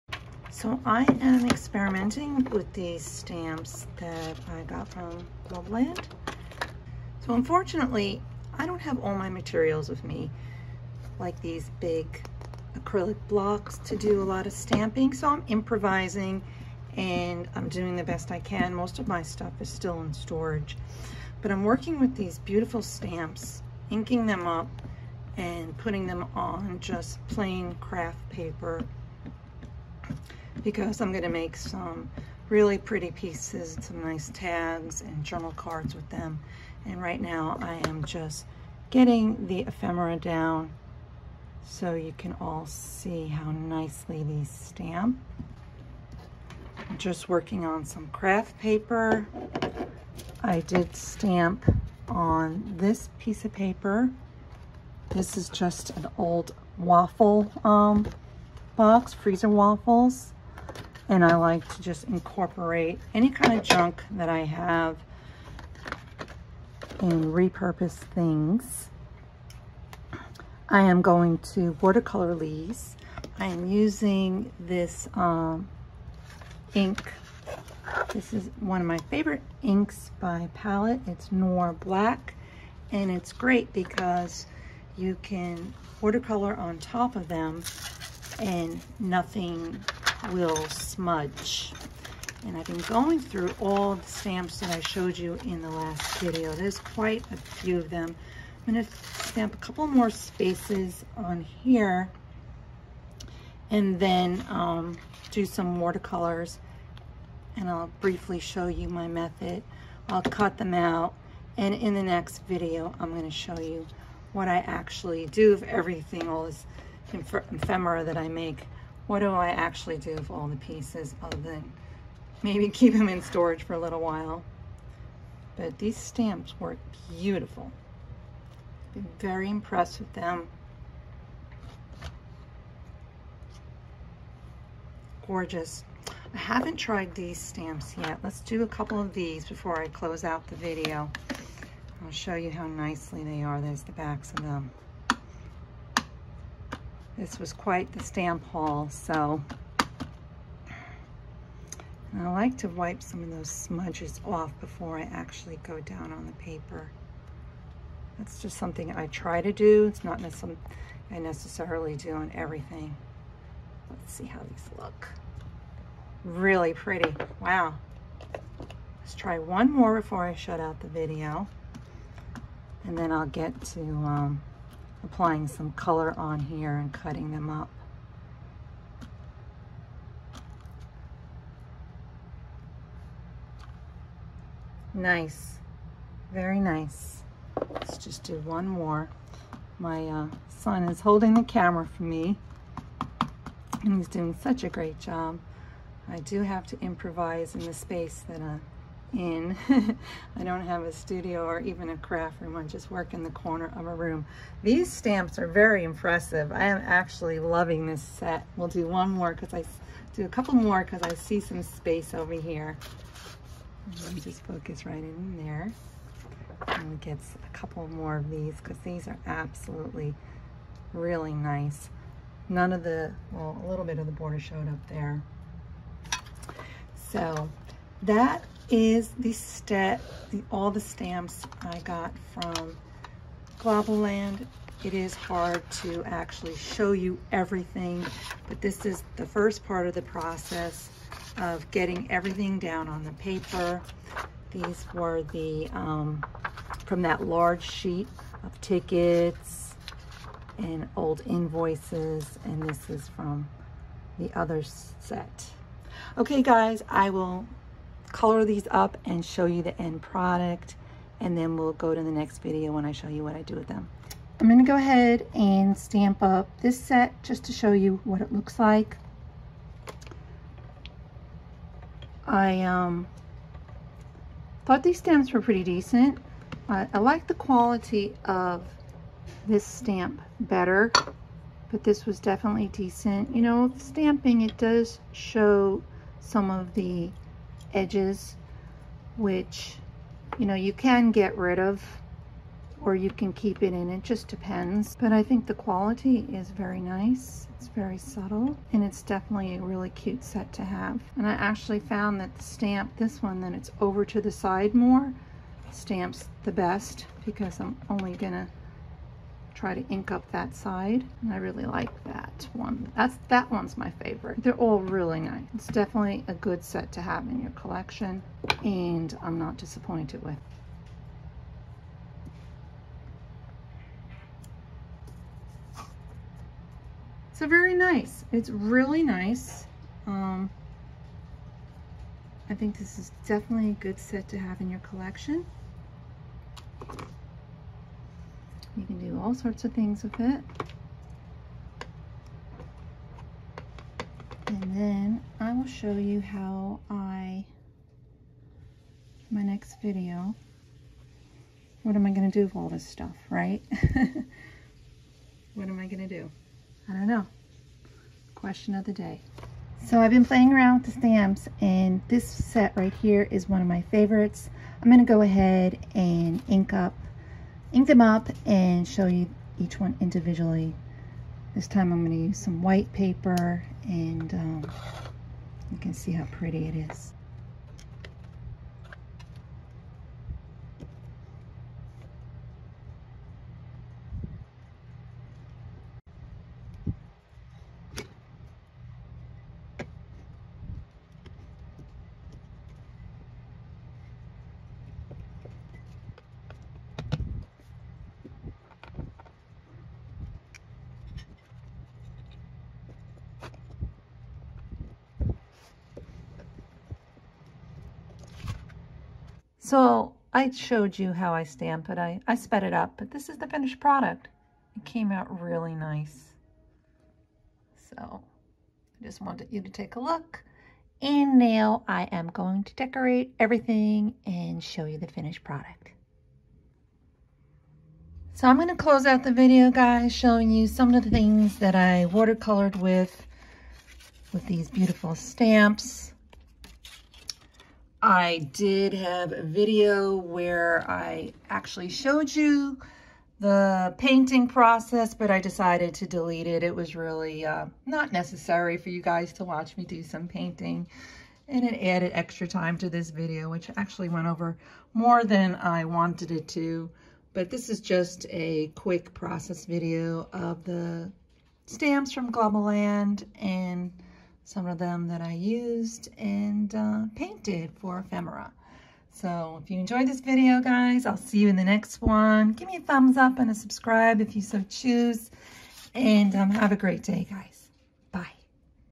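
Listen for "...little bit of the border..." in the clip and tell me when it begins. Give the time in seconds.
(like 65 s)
223 s.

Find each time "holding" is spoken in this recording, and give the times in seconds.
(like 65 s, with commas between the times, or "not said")
191 s.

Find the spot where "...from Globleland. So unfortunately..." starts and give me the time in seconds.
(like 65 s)
4 s.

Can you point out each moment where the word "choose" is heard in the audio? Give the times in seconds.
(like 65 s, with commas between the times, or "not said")
474 s.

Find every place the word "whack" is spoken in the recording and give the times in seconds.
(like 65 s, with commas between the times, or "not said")
not said.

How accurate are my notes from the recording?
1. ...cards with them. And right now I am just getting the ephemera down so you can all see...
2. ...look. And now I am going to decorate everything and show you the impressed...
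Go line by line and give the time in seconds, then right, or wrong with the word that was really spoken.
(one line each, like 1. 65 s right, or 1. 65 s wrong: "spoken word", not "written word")
1. 35 s right
2. 420 s wrong: "finished", not "impressed".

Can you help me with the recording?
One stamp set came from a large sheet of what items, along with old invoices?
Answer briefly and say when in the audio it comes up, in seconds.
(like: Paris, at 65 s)
tickets, at 248 s.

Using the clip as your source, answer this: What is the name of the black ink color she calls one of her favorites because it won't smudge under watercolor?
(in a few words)
Noir Black.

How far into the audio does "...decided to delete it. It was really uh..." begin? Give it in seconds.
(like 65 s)
445 s.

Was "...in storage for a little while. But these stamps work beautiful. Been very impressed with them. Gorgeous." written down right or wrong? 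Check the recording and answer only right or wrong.
right.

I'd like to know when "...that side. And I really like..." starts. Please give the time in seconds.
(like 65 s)
310 s.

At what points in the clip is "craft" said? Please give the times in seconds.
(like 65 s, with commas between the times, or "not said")
27 s, 48 s, 201 s.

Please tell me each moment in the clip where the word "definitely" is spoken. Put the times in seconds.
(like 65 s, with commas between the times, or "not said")
282 s, 299 s, 315 s, 333 s.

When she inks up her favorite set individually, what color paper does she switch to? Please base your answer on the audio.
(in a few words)
white.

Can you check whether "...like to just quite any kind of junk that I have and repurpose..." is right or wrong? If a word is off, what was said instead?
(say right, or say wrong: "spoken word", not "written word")
wrong: "incorporate", not "quite".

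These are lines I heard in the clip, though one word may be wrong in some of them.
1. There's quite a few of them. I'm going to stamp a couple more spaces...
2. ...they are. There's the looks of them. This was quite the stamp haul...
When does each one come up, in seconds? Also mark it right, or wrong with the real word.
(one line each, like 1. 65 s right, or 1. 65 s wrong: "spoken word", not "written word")
1. 96 s right
2. 143 s wrong: "backs", not "looks".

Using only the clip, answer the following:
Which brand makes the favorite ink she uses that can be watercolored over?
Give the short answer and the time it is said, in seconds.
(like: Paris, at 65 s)
Palette, at 80 s.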